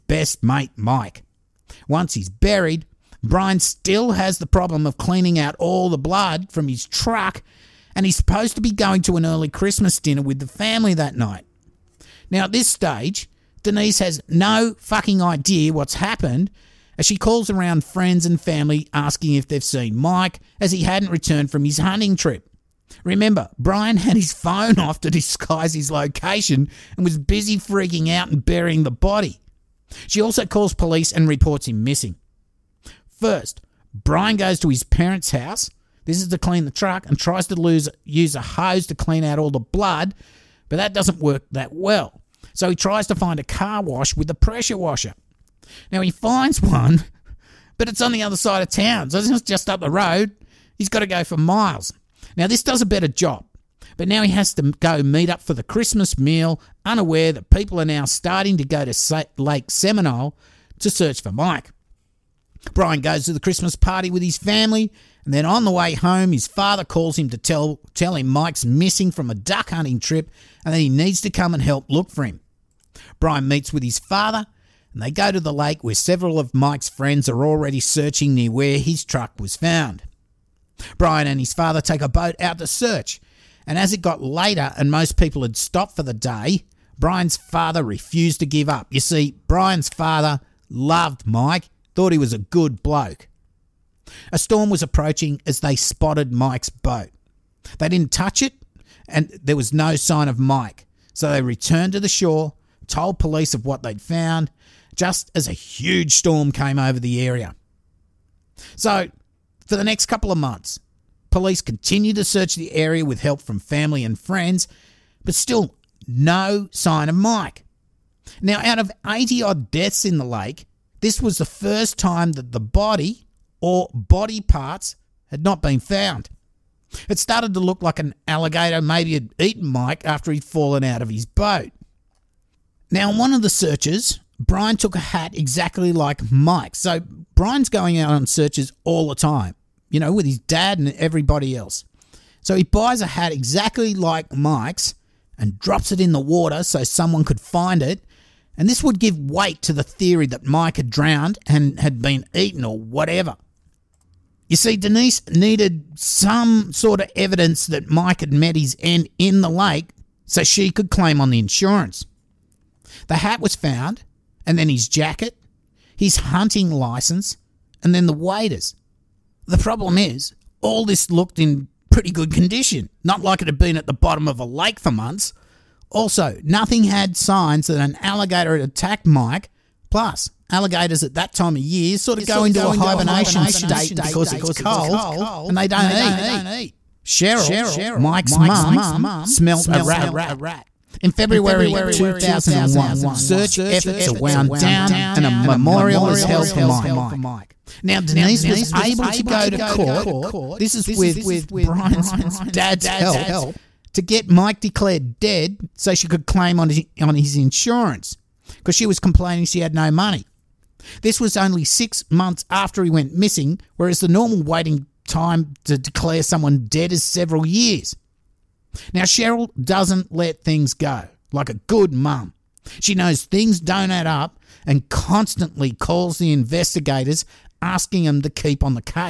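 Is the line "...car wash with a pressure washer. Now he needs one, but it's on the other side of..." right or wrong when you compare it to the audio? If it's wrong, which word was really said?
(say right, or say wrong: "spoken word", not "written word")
wrong: "finds", not "needs".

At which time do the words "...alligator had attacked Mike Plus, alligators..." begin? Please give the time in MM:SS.
02:58.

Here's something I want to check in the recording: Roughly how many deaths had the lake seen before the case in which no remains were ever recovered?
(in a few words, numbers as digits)
80.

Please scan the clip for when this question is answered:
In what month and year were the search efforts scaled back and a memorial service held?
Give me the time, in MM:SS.
03:11.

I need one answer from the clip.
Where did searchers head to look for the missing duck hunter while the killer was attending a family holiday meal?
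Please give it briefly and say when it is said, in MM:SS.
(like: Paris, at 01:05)
Lake Seminole, at 00:59.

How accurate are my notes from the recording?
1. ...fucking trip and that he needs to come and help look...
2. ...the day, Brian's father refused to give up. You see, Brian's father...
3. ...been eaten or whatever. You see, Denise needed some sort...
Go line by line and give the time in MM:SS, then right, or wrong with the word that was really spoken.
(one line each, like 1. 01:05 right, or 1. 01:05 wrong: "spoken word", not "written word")
1. 01:09 wrong: "hunting", not "fucking"
2. 01:26 right
3. 02:32 right.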